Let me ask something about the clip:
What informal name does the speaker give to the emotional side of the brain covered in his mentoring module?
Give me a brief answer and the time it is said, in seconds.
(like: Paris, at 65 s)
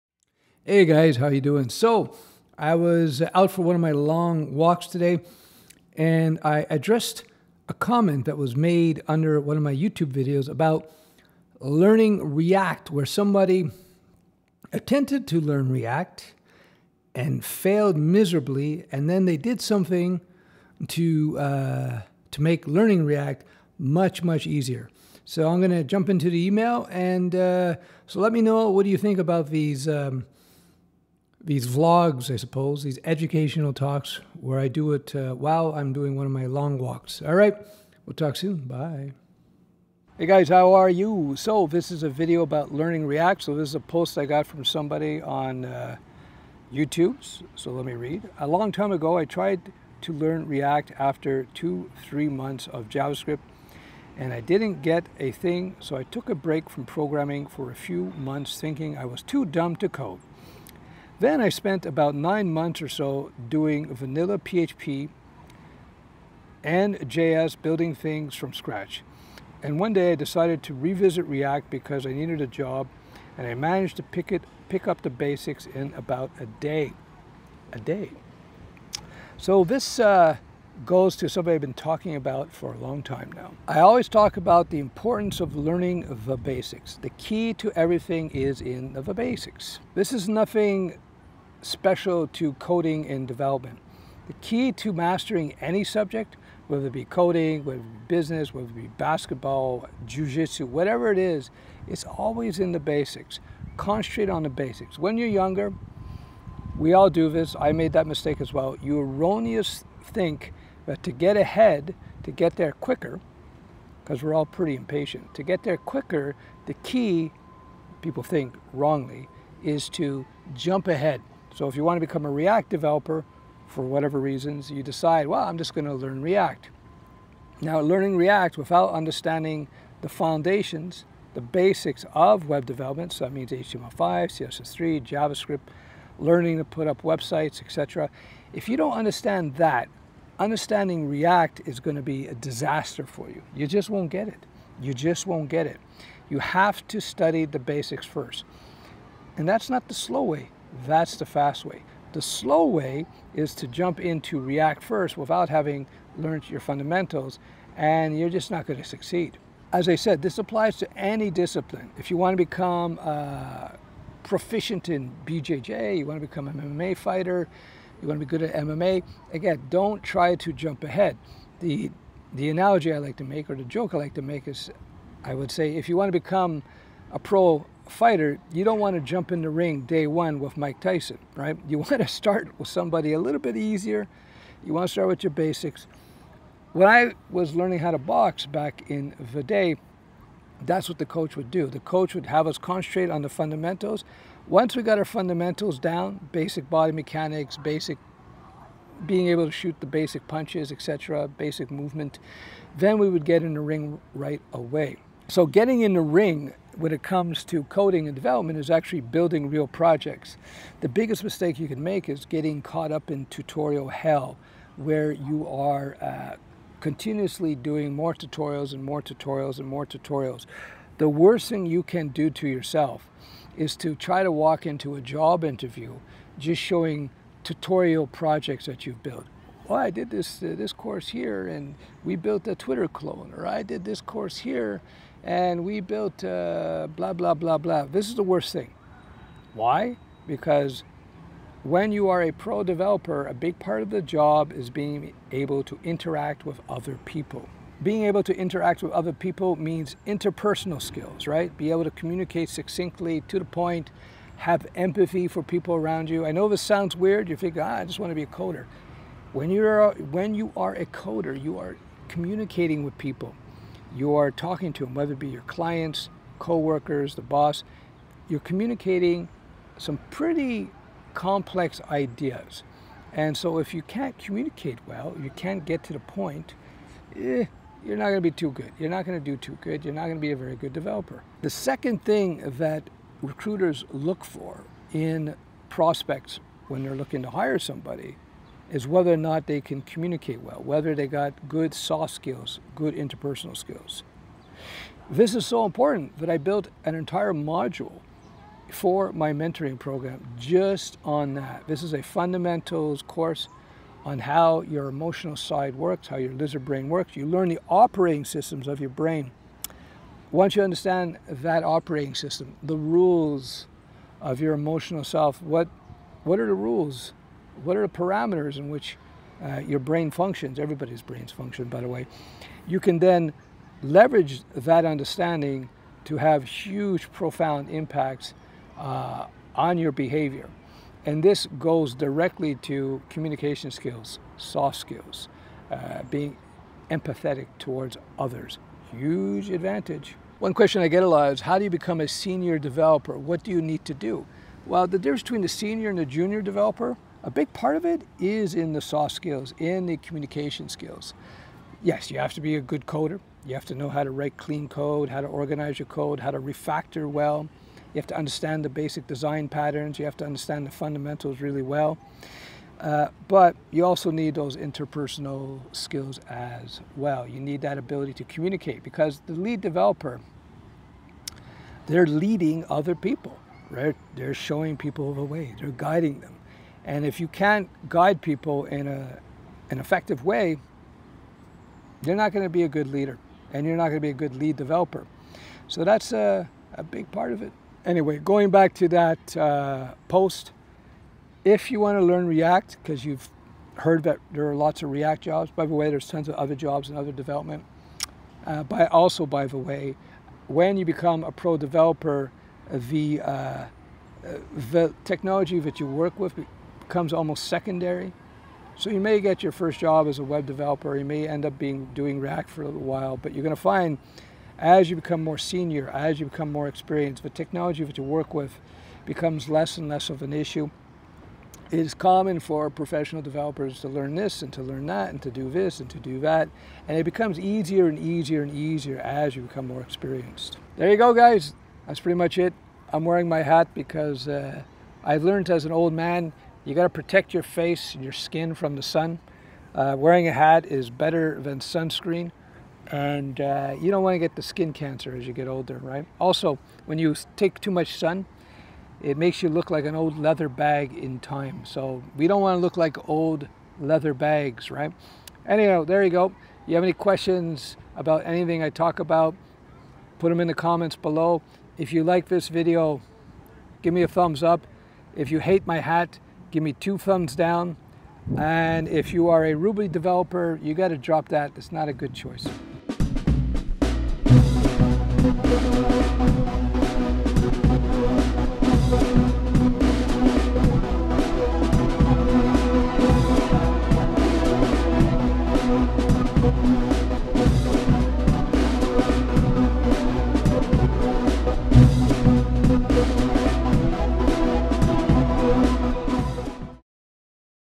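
Lizard brain, at 306 s.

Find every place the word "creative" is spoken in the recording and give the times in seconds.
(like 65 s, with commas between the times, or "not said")
not said.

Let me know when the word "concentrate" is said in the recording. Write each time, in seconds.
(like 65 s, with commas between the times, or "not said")
103 s, 192 s.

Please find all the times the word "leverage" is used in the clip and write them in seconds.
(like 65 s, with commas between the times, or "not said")
323 s.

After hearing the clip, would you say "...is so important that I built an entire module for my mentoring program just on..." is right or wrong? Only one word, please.
right.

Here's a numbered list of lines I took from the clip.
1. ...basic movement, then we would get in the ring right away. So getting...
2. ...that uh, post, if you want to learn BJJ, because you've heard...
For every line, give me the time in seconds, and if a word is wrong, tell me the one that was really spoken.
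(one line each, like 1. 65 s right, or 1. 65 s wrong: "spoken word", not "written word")
1. 201 s right
2. 388 s wrong: "React", not "BJJ".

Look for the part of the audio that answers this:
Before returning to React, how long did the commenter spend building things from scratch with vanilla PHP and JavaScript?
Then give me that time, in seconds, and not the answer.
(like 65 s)
62 s.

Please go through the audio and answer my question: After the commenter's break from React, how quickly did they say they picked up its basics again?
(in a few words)
A day.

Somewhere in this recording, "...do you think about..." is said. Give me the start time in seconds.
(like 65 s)
28 s.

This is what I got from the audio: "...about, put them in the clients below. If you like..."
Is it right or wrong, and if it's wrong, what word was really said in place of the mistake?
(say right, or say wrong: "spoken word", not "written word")
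wrong: "comments", not "clients".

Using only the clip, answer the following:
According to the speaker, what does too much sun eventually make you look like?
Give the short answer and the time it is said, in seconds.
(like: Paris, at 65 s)
An old leather bag, at 449 s.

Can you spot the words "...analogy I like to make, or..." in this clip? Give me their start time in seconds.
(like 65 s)
172 s.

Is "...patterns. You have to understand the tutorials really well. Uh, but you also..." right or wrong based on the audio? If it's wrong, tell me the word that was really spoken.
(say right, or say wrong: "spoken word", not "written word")
wrong: "fundamentals", not "tutorials".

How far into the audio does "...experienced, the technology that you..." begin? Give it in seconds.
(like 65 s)
416 s.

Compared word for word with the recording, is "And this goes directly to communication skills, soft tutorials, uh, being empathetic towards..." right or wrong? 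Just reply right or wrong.
wrong.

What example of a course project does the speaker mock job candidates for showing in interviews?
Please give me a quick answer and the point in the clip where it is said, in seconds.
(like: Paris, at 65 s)
A Twitter clone, at 232 s.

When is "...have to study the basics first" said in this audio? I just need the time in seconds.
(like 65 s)
146 s.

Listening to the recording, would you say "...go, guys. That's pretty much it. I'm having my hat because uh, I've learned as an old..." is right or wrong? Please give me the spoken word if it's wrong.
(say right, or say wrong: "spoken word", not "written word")
wrong: "wearing", not "having".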